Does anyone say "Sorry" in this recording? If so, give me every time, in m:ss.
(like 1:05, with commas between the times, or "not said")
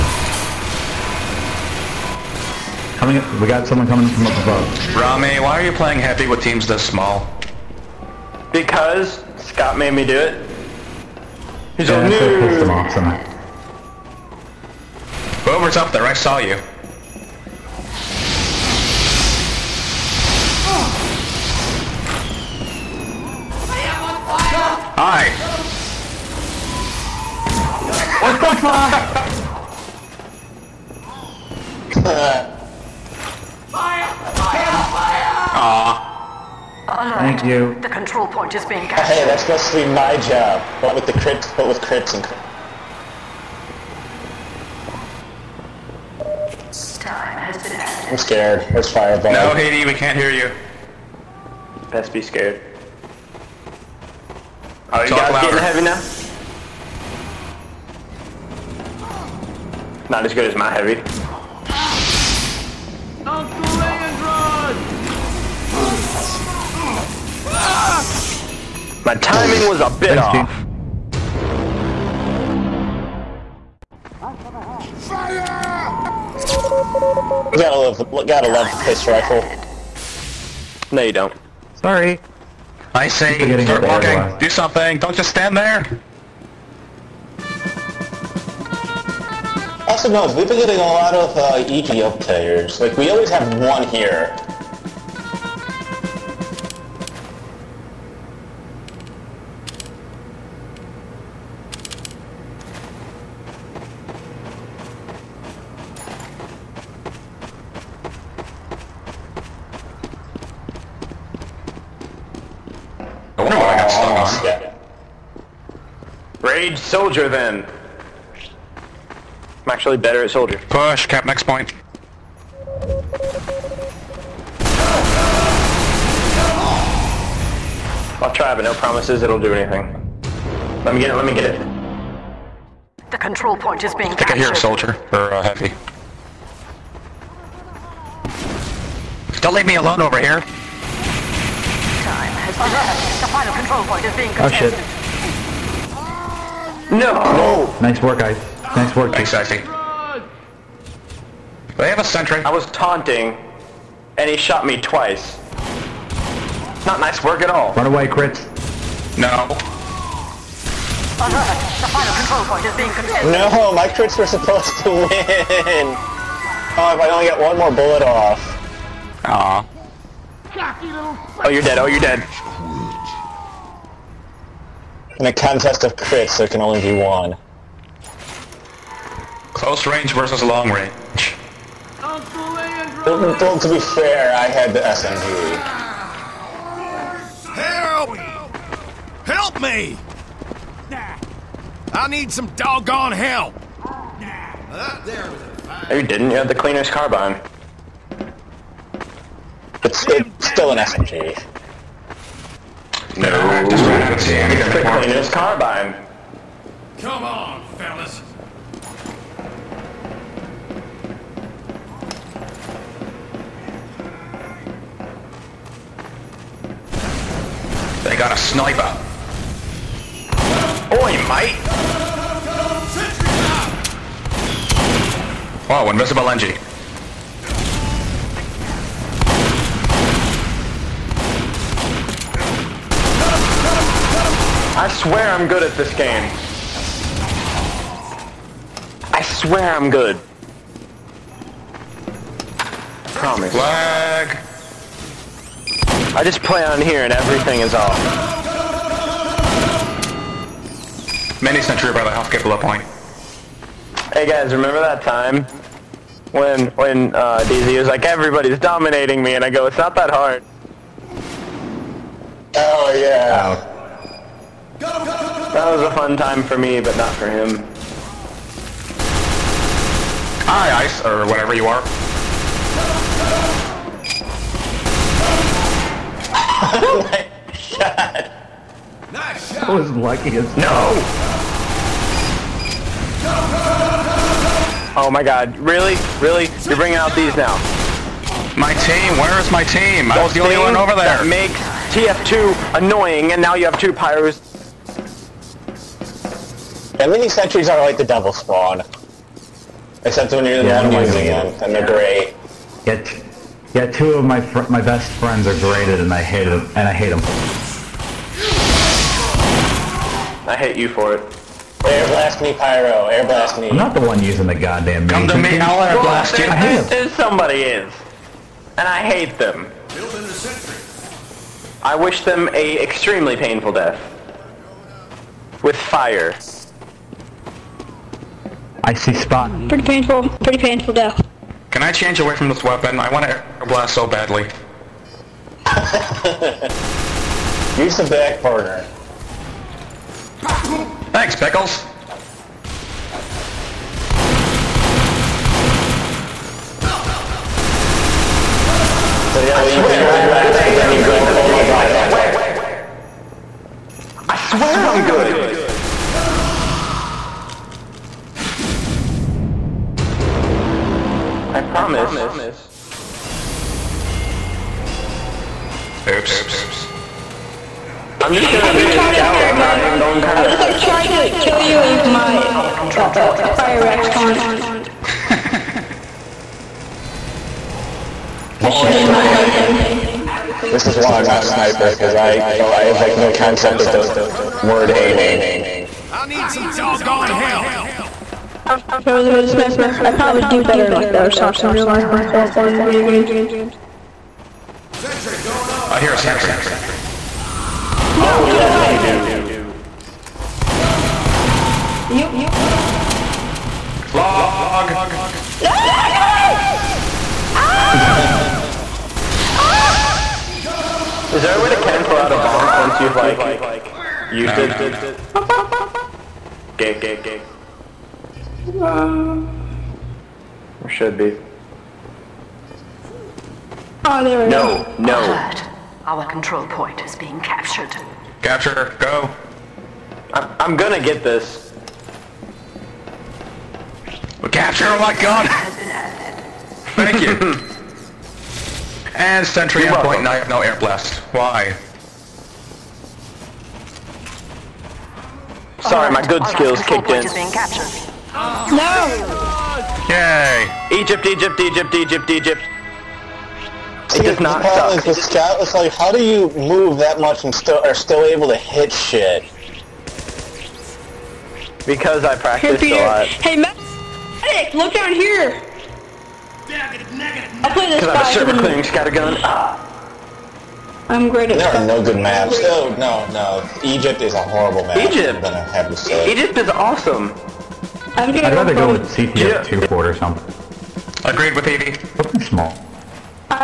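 1:21, 7:25.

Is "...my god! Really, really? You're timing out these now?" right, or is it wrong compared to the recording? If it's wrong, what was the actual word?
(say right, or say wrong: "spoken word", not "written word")
wrong: "bringing", not "timing".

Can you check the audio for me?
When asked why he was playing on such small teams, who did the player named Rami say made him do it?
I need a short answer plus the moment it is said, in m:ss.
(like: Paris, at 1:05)
Scott, at 0:09.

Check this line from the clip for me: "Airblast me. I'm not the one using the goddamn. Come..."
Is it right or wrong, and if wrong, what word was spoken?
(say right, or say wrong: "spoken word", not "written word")
right.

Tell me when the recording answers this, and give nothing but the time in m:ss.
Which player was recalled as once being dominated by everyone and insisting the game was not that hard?
4:17.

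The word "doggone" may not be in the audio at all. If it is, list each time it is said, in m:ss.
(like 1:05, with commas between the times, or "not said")
3:12, 6:26.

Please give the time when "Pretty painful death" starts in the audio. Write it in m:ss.
5:30.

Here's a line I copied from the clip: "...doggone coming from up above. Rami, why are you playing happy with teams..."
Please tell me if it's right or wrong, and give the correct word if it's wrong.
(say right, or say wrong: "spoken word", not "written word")
wrong: "someone", not "doggone".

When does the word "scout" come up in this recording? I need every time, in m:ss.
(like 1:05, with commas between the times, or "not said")
6:08, 7:35, 7:48.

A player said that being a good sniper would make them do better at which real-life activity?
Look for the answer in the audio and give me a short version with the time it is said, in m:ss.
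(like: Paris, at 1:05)
Airsoft, at 6:31.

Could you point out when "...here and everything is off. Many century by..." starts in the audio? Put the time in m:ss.
4:06.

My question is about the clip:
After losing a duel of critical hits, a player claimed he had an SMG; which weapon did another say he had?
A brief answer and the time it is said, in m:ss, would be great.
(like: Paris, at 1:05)
Cleaner's Carbine, at 3:16.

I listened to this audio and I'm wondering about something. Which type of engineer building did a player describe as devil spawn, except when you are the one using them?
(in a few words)
Mini sentries.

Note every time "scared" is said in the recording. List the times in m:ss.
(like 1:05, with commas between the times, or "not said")
0:48, 0:52.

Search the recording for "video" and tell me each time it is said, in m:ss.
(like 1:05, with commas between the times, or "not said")
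6:32.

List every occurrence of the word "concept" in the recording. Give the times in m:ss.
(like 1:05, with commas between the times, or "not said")
6:23.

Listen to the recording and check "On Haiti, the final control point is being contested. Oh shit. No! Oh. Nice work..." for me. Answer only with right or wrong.
wrong.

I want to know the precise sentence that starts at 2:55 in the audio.
In a contest of crits, there can only be one.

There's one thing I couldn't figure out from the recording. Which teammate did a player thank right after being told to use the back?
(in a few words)
Pickles.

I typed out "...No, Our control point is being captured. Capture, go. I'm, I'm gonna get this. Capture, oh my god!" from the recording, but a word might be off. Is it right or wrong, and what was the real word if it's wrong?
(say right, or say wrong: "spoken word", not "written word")
right.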